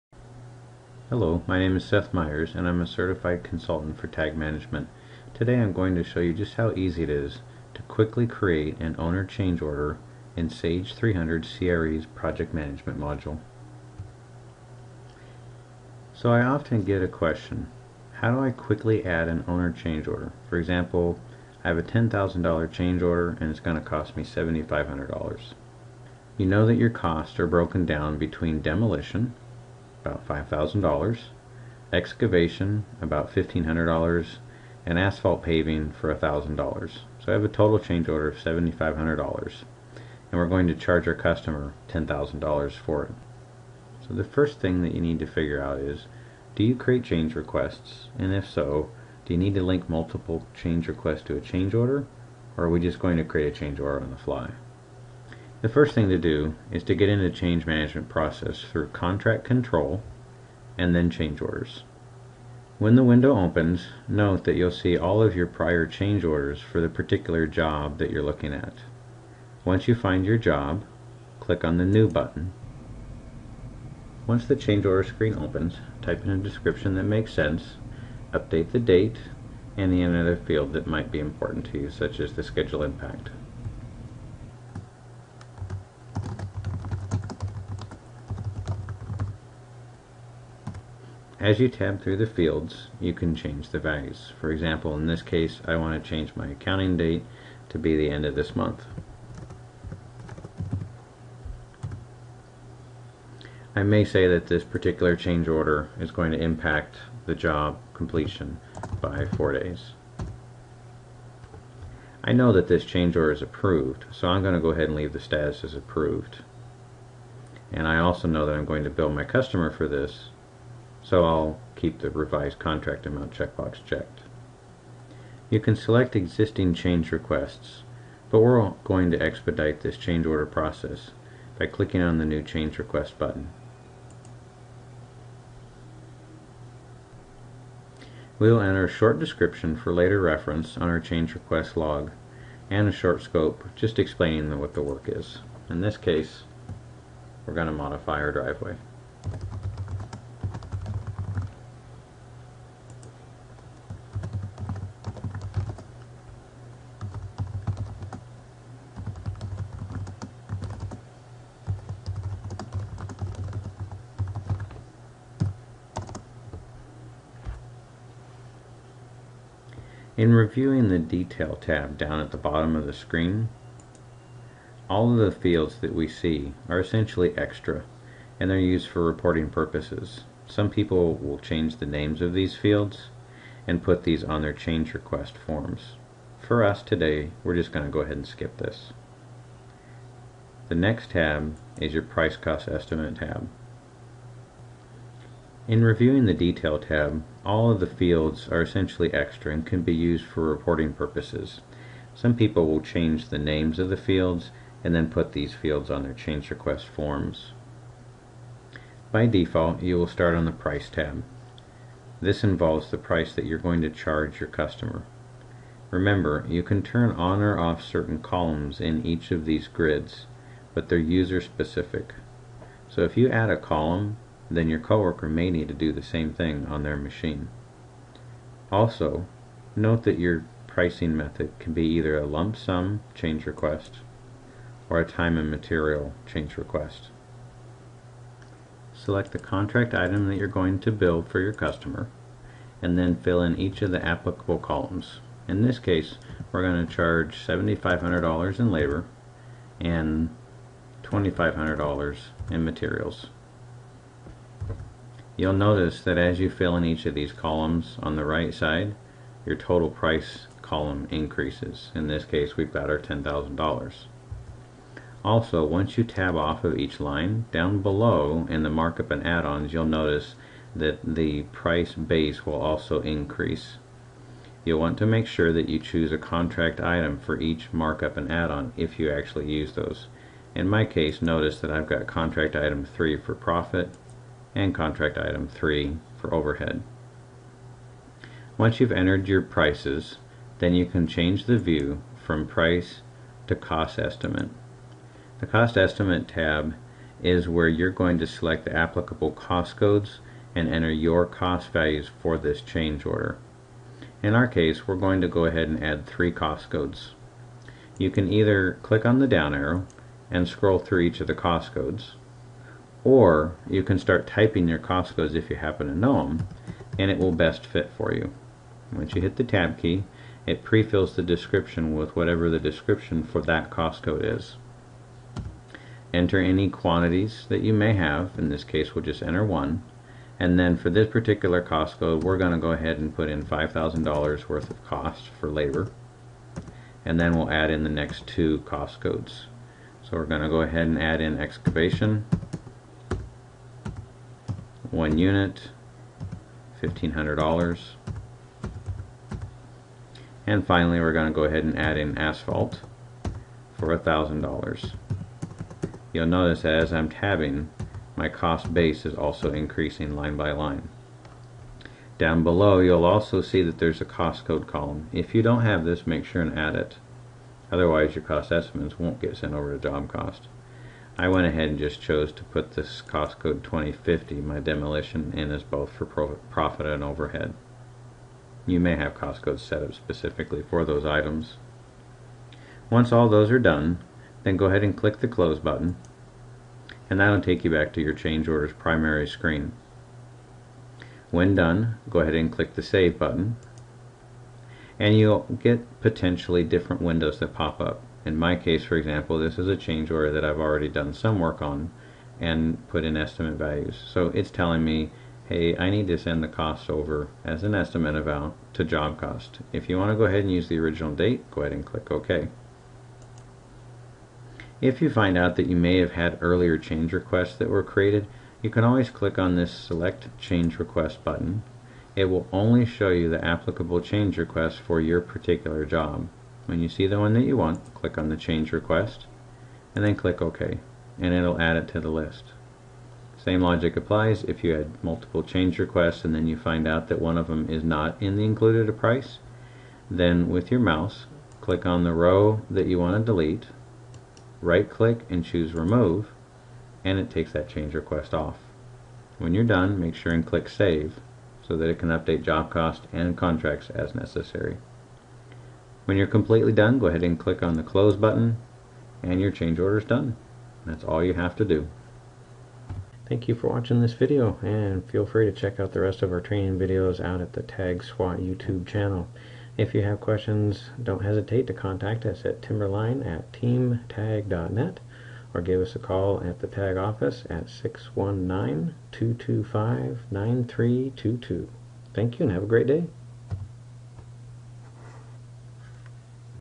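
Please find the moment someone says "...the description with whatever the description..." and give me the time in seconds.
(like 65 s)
321 s.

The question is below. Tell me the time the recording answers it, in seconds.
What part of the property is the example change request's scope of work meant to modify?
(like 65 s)
148 s.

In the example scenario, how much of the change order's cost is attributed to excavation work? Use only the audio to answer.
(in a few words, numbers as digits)
$1,500.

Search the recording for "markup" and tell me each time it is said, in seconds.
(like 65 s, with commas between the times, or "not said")
268 s, 277 s.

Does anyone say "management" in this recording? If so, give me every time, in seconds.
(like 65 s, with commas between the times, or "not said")
4 s, 12 s, 57 s.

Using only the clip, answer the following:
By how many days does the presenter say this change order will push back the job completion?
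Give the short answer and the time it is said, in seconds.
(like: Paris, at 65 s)
4, at 109 s.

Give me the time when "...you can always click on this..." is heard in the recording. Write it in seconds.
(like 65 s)
418 s.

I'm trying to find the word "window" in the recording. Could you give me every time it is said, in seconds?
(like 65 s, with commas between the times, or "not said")
63 s, 397 s.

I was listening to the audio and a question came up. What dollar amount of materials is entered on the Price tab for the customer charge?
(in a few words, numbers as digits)
$2,500.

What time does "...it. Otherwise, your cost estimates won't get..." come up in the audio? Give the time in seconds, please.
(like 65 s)
366 s.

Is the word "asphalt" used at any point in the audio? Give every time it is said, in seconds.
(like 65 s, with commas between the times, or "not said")
34 s, 352 s.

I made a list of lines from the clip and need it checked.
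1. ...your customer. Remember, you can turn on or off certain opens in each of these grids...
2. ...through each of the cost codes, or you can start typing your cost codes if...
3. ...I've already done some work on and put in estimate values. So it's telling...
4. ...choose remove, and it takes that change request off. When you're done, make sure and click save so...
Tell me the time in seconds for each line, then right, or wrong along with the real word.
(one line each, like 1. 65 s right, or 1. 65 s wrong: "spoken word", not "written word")
1. 214 s wrong: "columns", not "opens"
2. 310 s right
3. 400 s right
4. 445 s right.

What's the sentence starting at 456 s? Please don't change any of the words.
When you're completely done, go ahead and click on the close button and your change order is done.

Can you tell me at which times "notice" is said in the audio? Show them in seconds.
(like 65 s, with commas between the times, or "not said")
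255 s, 269 s, 281 s, 356 s.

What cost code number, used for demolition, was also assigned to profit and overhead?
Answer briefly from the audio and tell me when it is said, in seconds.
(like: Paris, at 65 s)
2050, at 373 s.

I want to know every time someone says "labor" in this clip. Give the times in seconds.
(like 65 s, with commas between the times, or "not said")
248 s, 335 s.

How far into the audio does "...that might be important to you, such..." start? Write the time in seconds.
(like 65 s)
80 s.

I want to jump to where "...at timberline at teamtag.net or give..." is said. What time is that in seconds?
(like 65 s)
472 s.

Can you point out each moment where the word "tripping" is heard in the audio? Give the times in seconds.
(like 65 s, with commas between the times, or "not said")
not said.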